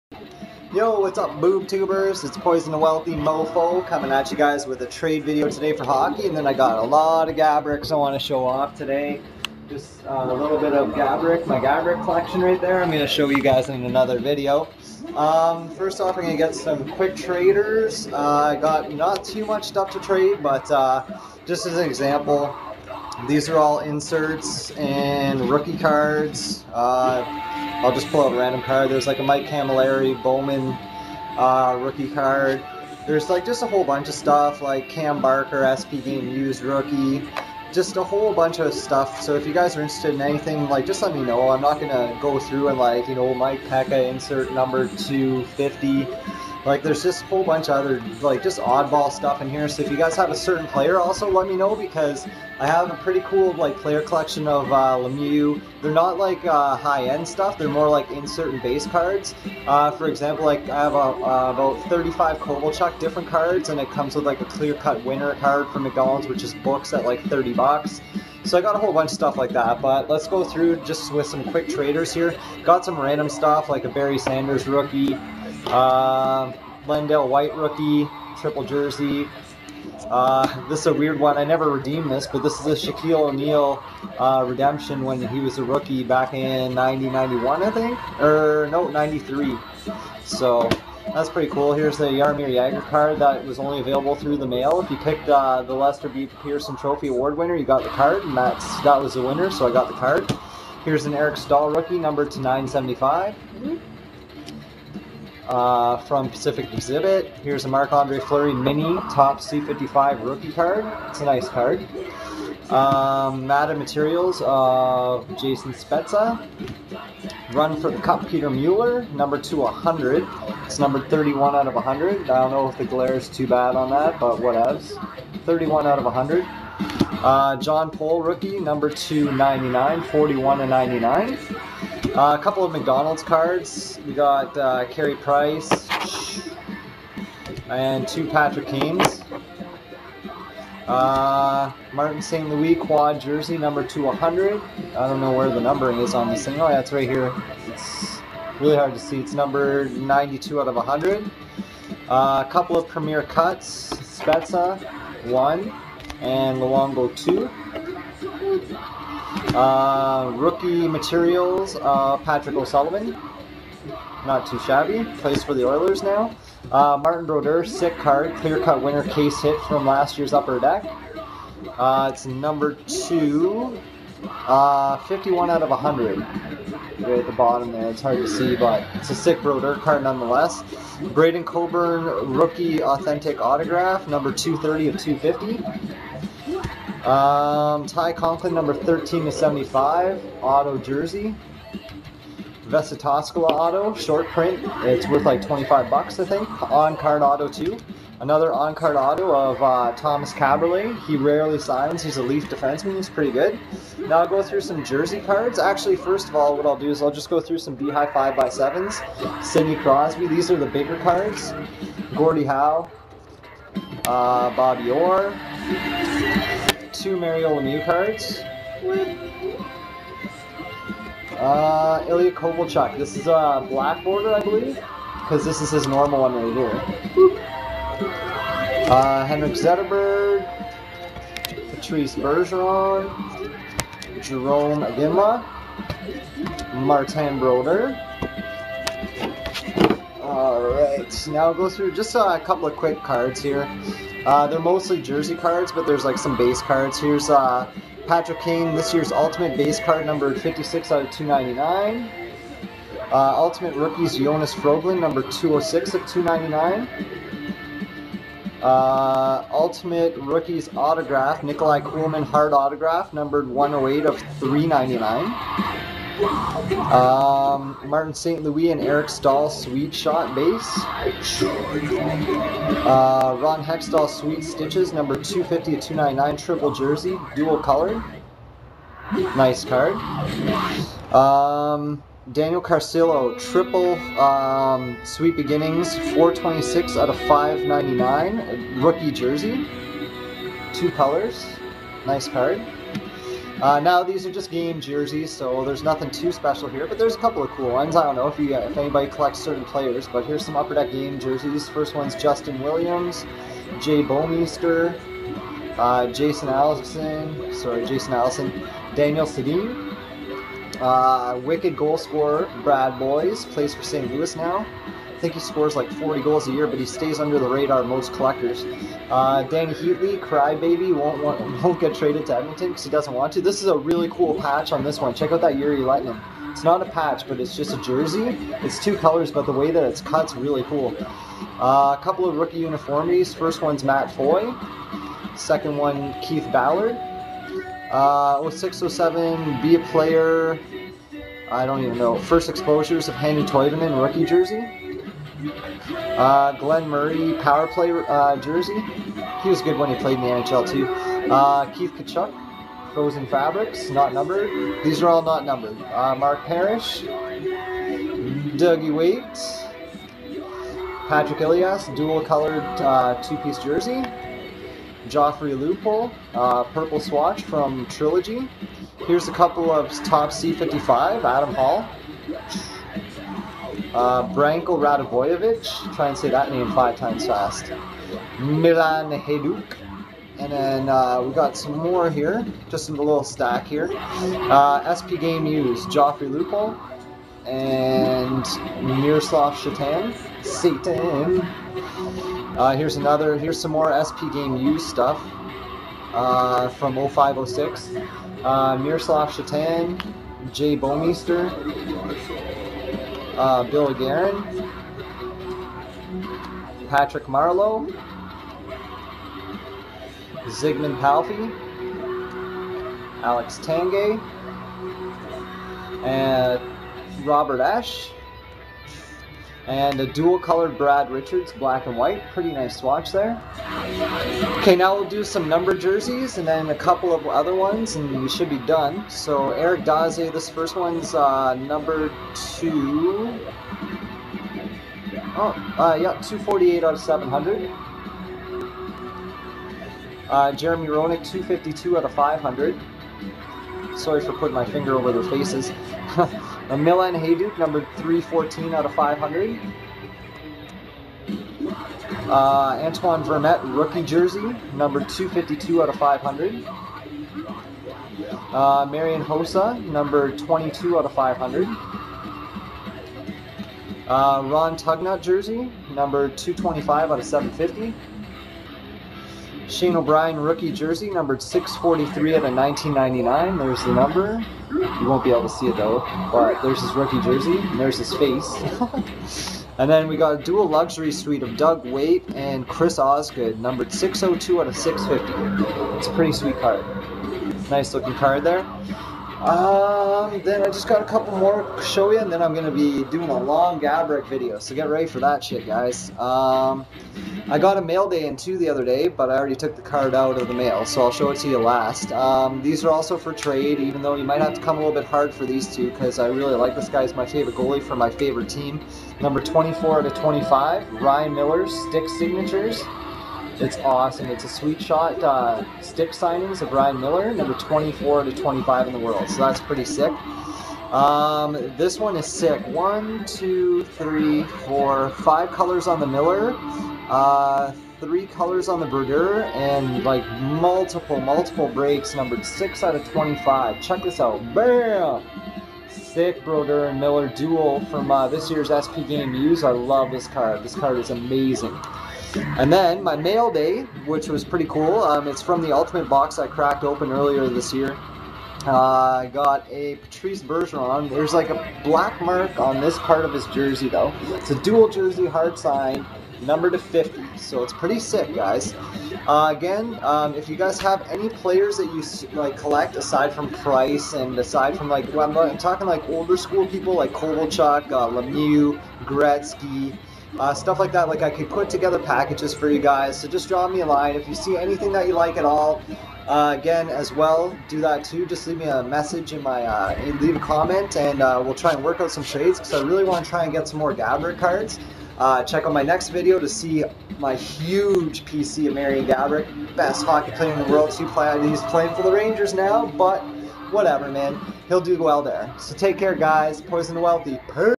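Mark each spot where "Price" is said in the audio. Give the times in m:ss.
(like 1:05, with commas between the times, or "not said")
2:15, 9:23.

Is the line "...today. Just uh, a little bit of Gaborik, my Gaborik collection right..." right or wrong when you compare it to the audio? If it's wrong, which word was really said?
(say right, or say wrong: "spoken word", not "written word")
right.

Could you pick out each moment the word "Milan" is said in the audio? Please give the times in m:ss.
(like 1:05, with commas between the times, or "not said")
6:18, 7:26.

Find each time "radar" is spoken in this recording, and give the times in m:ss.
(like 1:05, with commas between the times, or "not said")
5:17.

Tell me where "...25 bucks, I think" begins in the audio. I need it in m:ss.
3:15.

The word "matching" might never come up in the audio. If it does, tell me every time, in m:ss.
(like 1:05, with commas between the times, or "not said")
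not said.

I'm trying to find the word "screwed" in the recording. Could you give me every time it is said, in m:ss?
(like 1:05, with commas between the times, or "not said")
not said.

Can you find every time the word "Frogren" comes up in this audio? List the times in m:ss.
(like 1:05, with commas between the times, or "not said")
4:14.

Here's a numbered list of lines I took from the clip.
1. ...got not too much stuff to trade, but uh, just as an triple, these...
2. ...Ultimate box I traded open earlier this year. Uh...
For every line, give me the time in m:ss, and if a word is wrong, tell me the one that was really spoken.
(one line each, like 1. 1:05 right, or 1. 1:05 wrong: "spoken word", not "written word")
1. 0:18 wrong: "example", not "triple"
2. 9:05 wrong: "cracked", not "traded".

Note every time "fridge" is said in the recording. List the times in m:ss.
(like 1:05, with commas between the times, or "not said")
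not said.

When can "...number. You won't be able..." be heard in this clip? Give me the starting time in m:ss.
7:53.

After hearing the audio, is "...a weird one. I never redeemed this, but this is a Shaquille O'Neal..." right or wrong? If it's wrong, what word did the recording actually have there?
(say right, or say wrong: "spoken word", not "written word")
right.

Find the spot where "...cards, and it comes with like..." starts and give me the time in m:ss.
1:03.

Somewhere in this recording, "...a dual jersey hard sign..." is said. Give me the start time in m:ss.
9:14.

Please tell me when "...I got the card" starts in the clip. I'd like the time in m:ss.
1:39.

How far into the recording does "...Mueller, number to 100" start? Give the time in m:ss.
1:58.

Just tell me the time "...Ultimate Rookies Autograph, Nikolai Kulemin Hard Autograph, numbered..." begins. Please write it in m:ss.
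4:19.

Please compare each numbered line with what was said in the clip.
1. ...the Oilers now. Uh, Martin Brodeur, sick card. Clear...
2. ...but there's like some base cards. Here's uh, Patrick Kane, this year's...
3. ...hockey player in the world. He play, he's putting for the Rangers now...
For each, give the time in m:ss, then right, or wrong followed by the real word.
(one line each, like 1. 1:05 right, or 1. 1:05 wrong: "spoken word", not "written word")
1. 2:45 right
2. 4:05 right
3. 9:50 wrong: "playing", not "putting".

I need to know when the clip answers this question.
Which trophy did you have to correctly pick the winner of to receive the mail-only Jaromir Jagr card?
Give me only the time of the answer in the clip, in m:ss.
1:35.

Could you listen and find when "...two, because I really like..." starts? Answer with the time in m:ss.
8:25.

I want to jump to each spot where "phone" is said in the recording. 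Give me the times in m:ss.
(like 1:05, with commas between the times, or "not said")
not said.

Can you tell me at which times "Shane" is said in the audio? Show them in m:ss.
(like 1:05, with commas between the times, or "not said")
7:49.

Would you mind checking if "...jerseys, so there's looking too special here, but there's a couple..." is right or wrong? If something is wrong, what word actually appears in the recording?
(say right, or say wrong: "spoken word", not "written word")
wrong: "nothing", not "looking".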